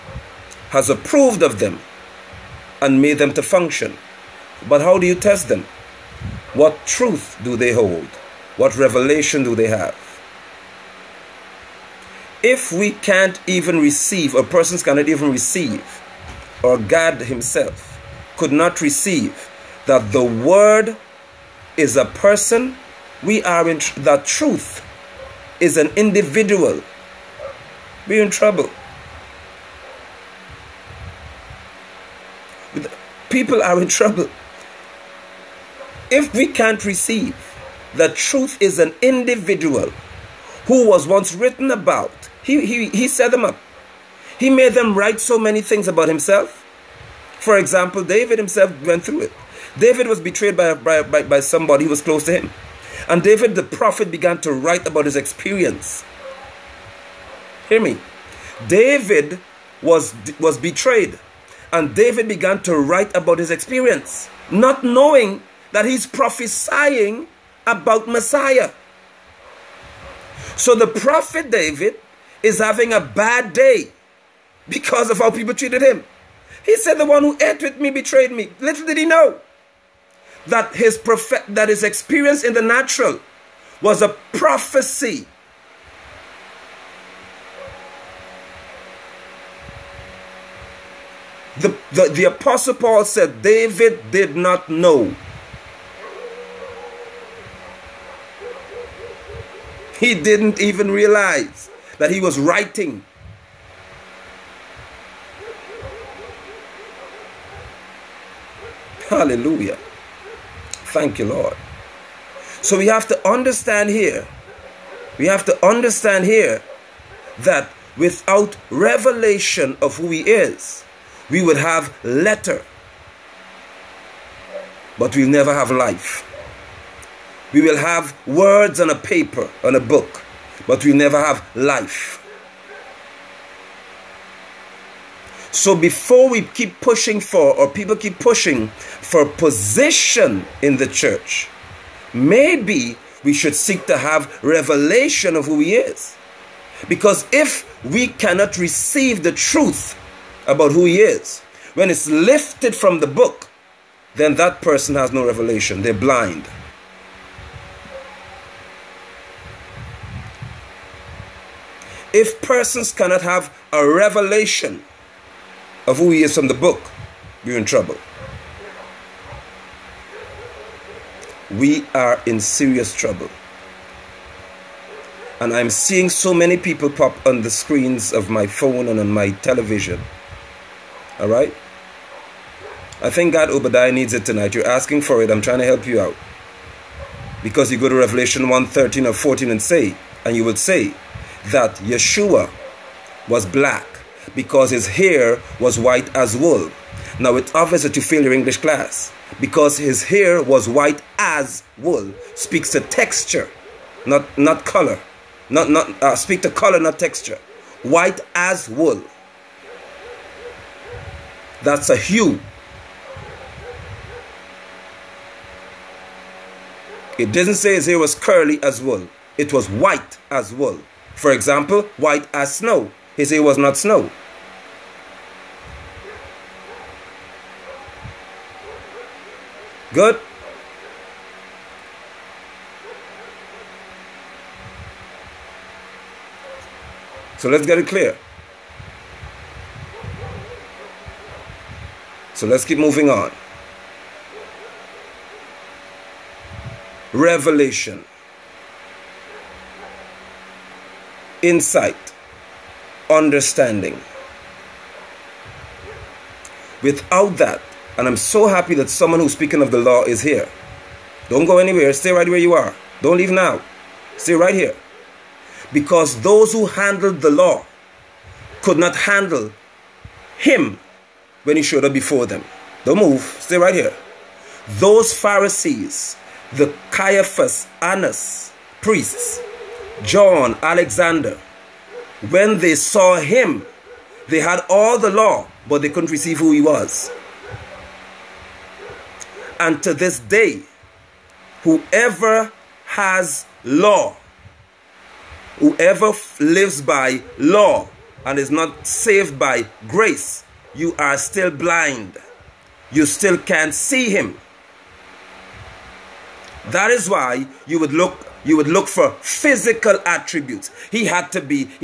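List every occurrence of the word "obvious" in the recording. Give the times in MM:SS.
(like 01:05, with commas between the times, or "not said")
03:17.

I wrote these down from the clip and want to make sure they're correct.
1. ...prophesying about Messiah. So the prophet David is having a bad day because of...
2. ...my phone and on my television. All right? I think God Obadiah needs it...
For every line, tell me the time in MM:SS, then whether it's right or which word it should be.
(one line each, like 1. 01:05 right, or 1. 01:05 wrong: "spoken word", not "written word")
1. 01:06 right
2. 02:58 right.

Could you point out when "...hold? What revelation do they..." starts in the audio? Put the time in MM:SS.
00:07.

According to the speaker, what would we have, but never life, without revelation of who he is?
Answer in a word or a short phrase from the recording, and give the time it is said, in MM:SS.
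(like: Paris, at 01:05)
Letter, at 02:02.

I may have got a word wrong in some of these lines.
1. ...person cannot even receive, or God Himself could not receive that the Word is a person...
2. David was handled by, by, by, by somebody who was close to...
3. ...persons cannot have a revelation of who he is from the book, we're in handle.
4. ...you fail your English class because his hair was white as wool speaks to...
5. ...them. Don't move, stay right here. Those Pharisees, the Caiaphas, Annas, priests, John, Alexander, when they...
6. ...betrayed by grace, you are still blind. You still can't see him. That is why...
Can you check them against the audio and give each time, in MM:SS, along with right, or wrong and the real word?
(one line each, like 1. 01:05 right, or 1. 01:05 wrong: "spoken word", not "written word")
1. 00:14 right
2. 00:49 wrong: "betrayed", not "handled"
3. 02:42 wrong: "trouble", not "handle"
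4. 03:17 right
5. 04:32 right
6. 04:58 wrong: "saved", not "betrayed".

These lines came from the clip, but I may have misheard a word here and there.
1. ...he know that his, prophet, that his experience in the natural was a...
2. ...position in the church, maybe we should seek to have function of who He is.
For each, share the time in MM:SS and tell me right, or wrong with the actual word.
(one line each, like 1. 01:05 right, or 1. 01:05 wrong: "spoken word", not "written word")
1. 01:18 right
2. 02:19 wrong: "revelation", not "function".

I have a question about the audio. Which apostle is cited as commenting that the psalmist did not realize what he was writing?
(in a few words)
Paul.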